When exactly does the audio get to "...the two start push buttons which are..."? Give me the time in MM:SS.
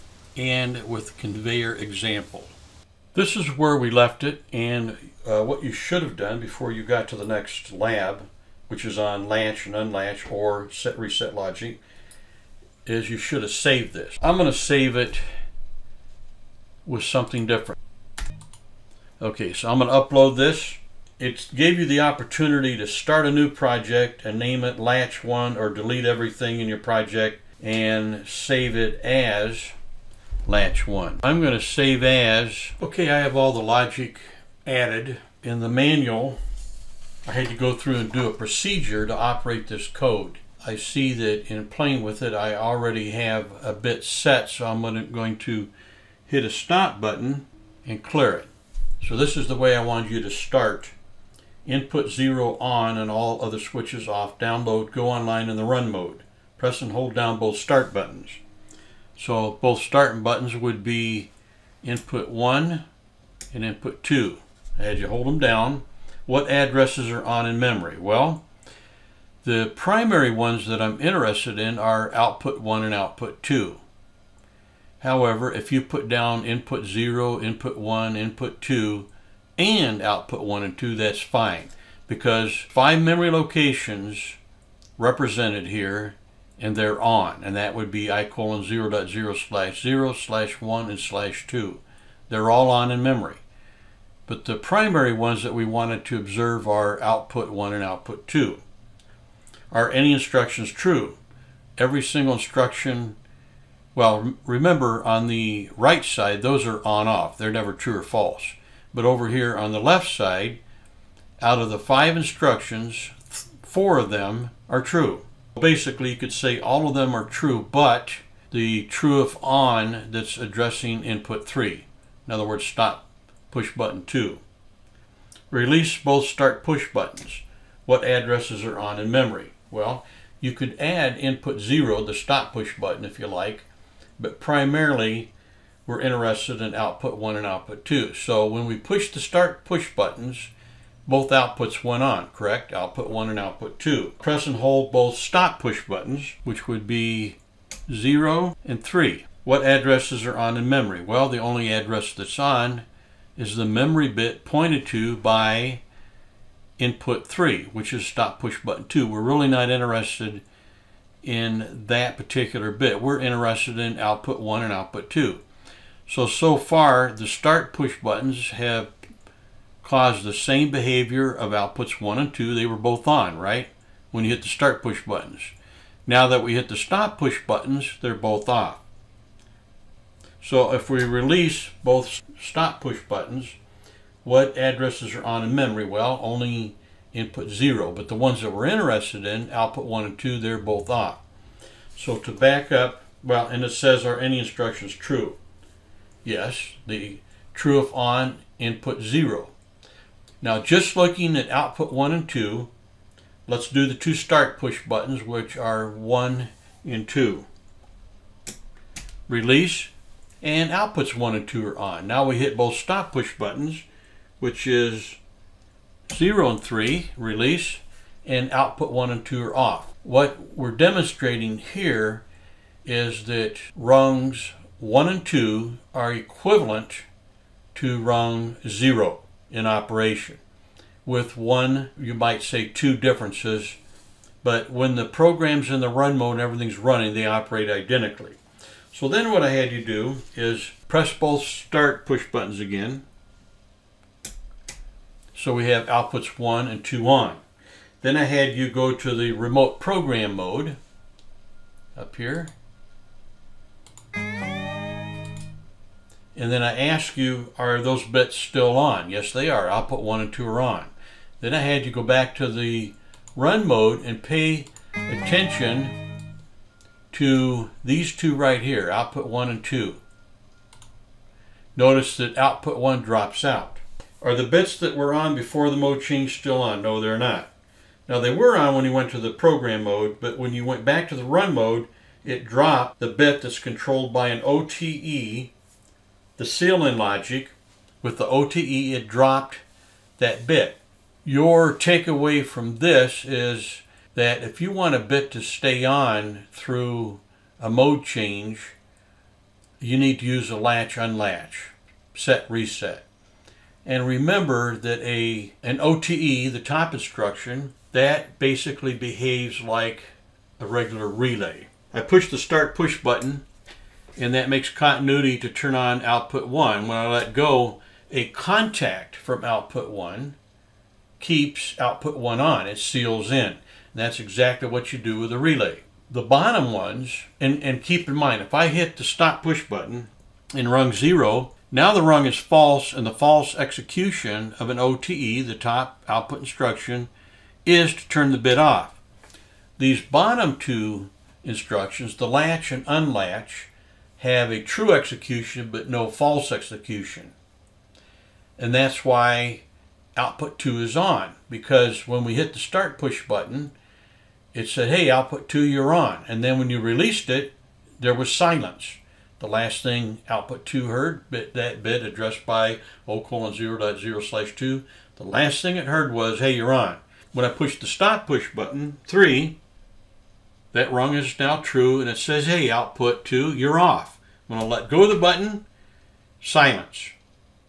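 03:23.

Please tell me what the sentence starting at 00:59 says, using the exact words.
So both start buttons would be input 1 and input 2.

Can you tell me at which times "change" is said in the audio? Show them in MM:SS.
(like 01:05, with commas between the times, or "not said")
04:36, 04:58.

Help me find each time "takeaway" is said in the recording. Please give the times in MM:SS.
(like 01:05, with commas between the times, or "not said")
04:51.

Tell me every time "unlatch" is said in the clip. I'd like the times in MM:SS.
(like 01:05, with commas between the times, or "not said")
00:09, 05:00, 05:42.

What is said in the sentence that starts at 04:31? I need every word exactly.
Notice that output one drops out.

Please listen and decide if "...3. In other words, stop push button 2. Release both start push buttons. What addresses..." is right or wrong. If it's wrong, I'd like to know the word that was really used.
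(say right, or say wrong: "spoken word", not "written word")
right.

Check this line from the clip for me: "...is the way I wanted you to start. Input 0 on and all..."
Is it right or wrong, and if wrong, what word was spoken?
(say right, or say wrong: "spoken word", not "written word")
right.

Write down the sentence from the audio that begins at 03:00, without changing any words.
So if we release both stop push buttons, what addresses are on in memory?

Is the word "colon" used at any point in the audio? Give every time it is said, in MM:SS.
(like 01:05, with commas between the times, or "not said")
01:28, 06:03.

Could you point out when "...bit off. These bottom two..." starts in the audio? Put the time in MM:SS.
05:38.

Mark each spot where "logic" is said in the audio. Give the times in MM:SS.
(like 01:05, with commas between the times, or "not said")
00:11, 00:33, 04:46.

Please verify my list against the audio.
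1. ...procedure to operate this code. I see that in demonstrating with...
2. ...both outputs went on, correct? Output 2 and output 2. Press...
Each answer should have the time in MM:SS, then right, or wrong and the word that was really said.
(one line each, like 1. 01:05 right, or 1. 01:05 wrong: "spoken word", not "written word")
1. 00:38 wrong: "playing", not "demonstrating"
2. 02:21 wrong: "1", not "2".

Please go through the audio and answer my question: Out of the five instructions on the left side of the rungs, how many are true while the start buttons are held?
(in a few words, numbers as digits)
4.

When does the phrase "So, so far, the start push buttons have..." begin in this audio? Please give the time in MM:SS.
02:46.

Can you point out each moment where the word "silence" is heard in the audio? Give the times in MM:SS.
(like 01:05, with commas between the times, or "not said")
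05:58, 06:16.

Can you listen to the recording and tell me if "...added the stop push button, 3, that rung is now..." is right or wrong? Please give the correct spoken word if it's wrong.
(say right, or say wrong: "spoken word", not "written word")
wrong: "pushed", not "added".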